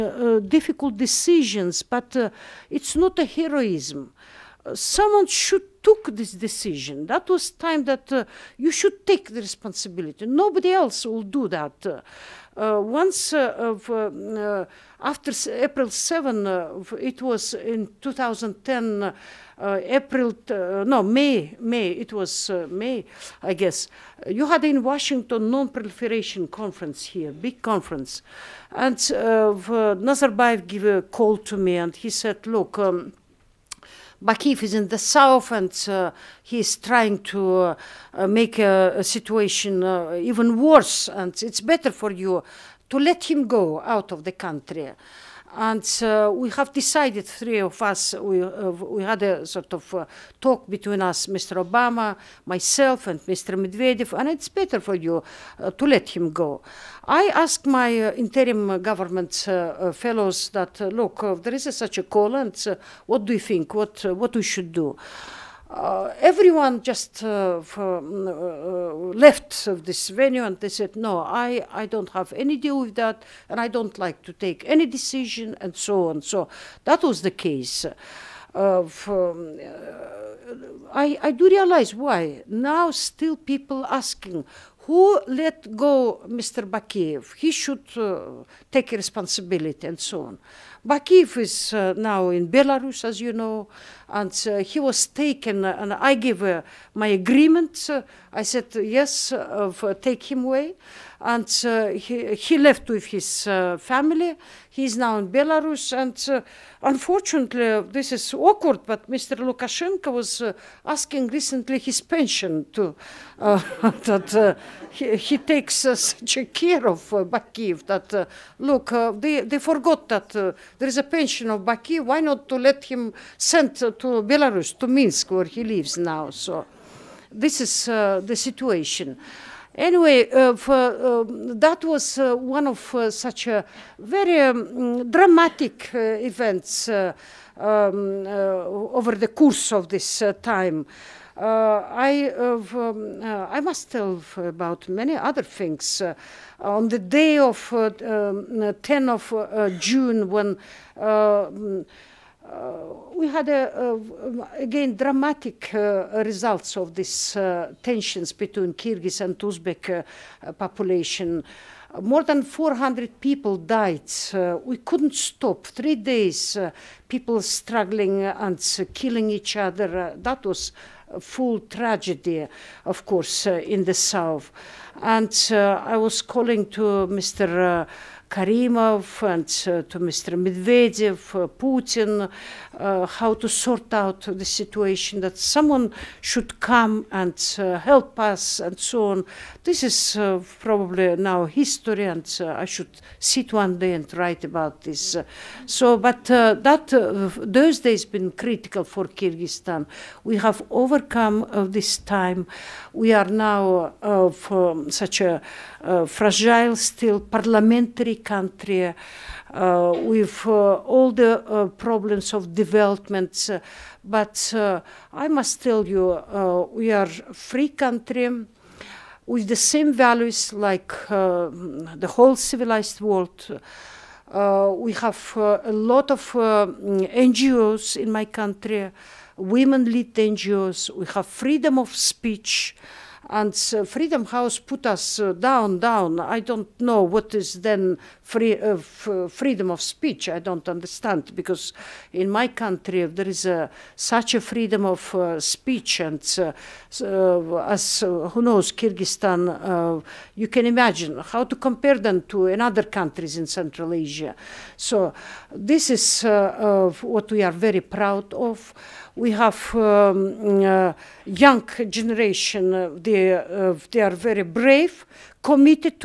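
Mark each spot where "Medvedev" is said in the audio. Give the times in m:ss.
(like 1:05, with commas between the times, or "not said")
0:53, 3:00.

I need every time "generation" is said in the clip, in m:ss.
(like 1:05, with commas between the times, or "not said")
4:21.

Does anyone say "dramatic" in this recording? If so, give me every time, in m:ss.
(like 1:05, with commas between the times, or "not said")
2:15, 2:34.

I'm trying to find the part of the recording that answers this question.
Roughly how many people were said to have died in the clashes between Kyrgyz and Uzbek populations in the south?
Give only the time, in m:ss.
2:42.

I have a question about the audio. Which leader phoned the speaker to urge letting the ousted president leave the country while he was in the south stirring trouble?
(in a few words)
Nazarbayev.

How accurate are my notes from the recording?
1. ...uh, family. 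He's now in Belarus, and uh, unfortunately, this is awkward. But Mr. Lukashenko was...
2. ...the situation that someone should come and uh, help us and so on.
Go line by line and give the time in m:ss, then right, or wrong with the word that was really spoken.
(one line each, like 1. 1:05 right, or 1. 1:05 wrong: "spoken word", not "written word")
1. 1:43 right
2. 3:04 right.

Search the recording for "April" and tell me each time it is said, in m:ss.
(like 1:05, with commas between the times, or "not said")
0:15, 0:19.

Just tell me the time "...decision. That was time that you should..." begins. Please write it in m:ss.
0:06.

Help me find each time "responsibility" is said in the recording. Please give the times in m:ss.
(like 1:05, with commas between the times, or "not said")
0:09, 1:28.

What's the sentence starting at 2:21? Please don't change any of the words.
Uh, I, uh, um, uh, I must tell about many other things.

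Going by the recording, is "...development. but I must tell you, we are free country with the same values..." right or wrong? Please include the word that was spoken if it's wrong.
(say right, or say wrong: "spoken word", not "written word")
right.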